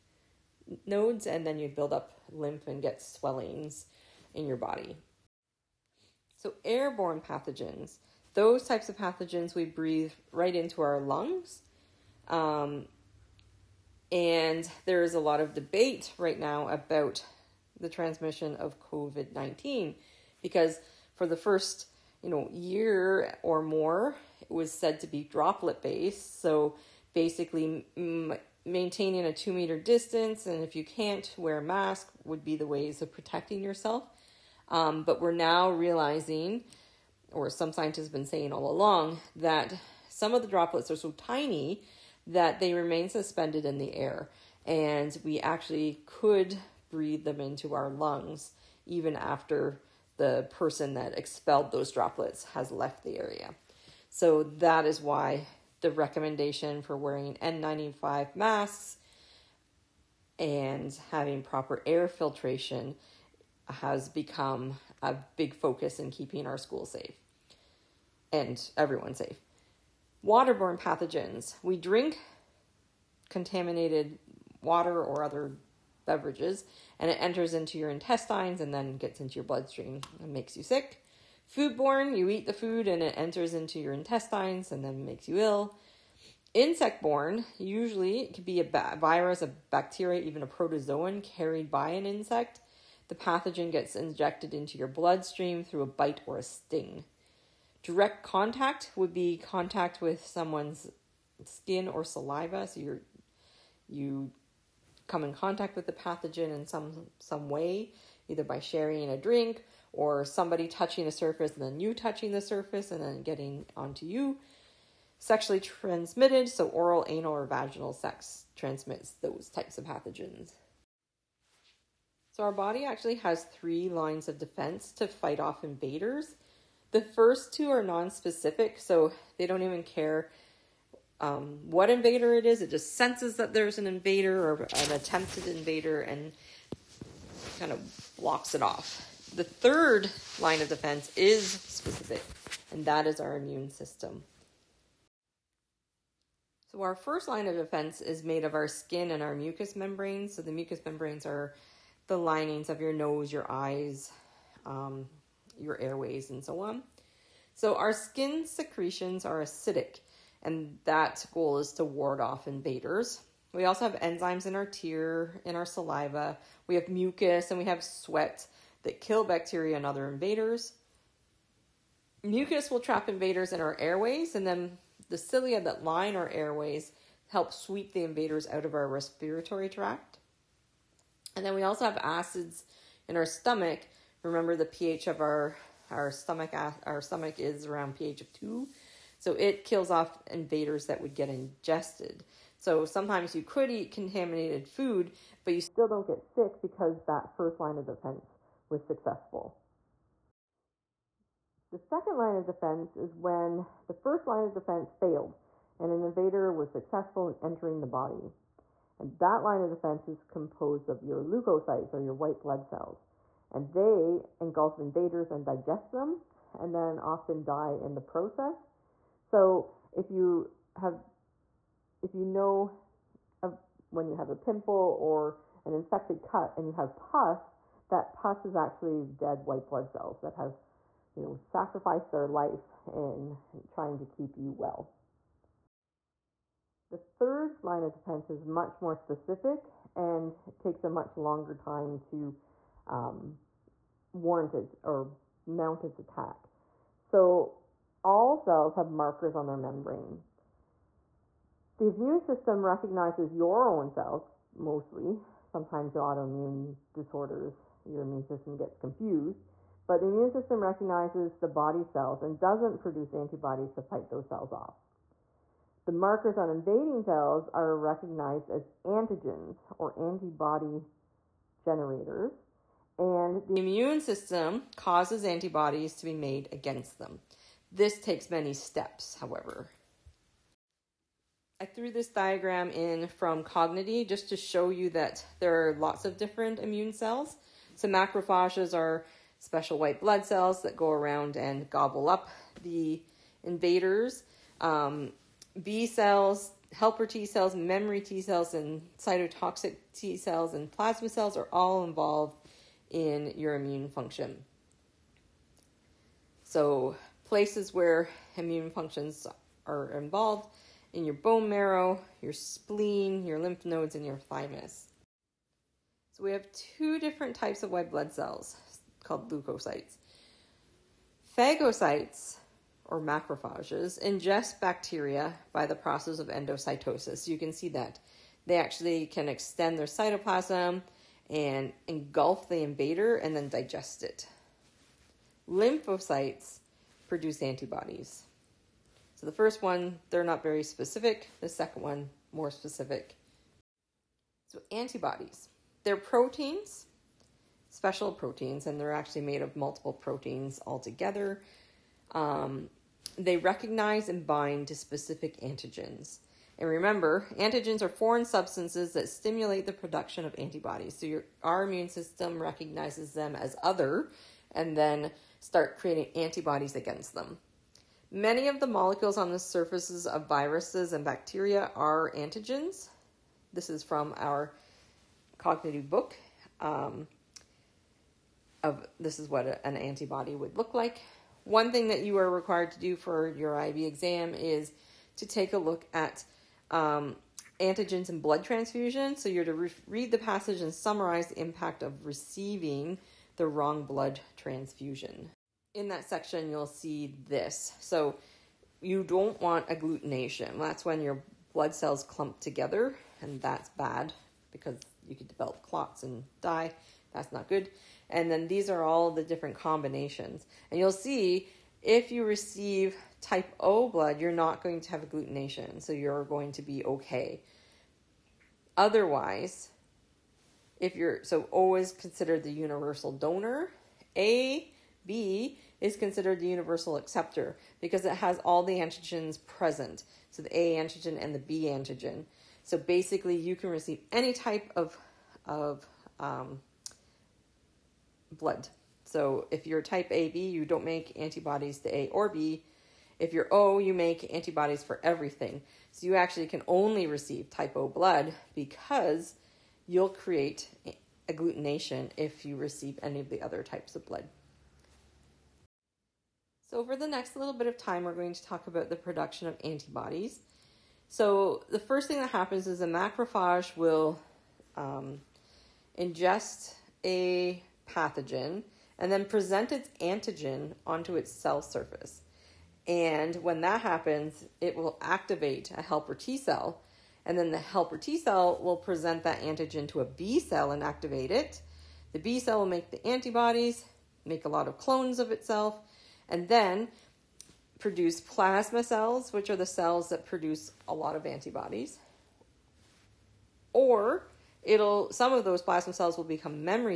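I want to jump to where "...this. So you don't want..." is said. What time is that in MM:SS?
06:37.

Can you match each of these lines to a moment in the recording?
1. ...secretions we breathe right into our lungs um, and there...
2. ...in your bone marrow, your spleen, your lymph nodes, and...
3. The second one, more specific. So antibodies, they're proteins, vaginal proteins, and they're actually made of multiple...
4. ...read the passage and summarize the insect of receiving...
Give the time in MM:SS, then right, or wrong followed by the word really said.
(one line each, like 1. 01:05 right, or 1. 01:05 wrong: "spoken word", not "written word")
1. 00:08 wrong: "pathogens", not "secretions"
2. 05:10 right
3. 05:41 wrong: "special", not "vaginal"
4. 06:29 wrong: "impact", not "insect".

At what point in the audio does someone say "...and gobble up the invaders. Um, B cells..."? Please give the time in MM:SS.
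04:51.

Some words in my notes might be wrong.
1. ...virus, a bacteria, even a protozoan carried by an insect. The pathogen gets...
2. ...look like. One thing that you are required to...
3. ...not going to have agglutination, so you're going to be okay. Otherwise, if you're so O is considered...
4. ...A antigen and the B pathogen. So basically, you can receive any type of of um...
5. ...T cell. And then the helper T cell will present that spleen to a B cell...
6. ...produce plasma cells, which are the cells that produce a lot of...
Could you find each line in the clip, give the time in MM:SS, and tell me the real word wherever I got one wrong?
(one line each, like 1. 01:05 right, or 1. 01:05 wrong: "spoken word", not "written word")
1. 01:28 right
2. 06:20 right
3. 06:54 right
4. 07:10 wrong: "antigen", not "pathogen"
5. 07:56 wrong: "antigen", not "spleen"
6. 08:07 right.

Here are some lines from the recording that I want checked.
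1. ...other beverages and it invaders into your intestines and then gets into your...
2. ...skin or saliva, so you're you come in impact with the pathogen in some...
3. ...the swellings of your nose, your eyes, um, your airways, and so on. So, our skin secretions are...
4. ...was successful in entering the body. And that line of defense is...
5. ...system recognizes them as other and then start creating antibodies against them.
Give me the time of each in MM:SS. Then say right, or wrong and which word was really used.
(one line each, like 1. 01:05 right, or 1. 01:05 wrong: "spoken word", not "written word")
1. 01:15 wrong: "enters", not "invaders"
2. 01:41 wrong: "contact", not "impact"
3. 02:32 wrong: "linings", not "swellings"
4. 03:26 right
5. 06:01 right.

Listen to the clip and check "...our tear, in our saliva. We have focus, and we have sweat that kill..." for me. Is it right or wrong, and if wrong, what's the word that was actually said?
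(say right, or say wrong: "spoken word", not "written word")
wrong: "mucus", not "focus".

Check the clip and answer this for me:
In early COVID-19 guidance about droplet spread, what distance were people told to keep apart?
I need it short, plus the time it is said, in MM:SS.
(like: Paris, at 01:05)
2 meters, at 00:29.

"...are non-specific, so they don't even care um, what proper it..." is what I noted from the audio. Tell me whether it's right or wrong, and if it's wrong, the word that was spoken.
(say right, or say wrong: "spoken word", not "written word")
wrong: "invader", not "proper".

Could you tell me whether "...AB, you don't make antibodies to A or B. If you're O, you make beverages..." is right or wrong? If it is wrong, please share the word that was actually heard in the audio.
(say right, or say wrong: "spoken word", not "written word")
wrong: "antibodies", not "beverages".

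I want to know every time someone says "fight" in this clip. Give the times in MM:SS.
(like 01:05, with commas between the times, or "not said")
02:05, 04:23.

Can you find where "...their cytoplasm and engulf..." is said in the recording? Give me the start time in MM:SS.
05:29.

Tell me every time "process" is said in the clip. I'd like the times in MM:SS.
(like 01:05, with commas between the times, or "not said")
03:37, 05:25.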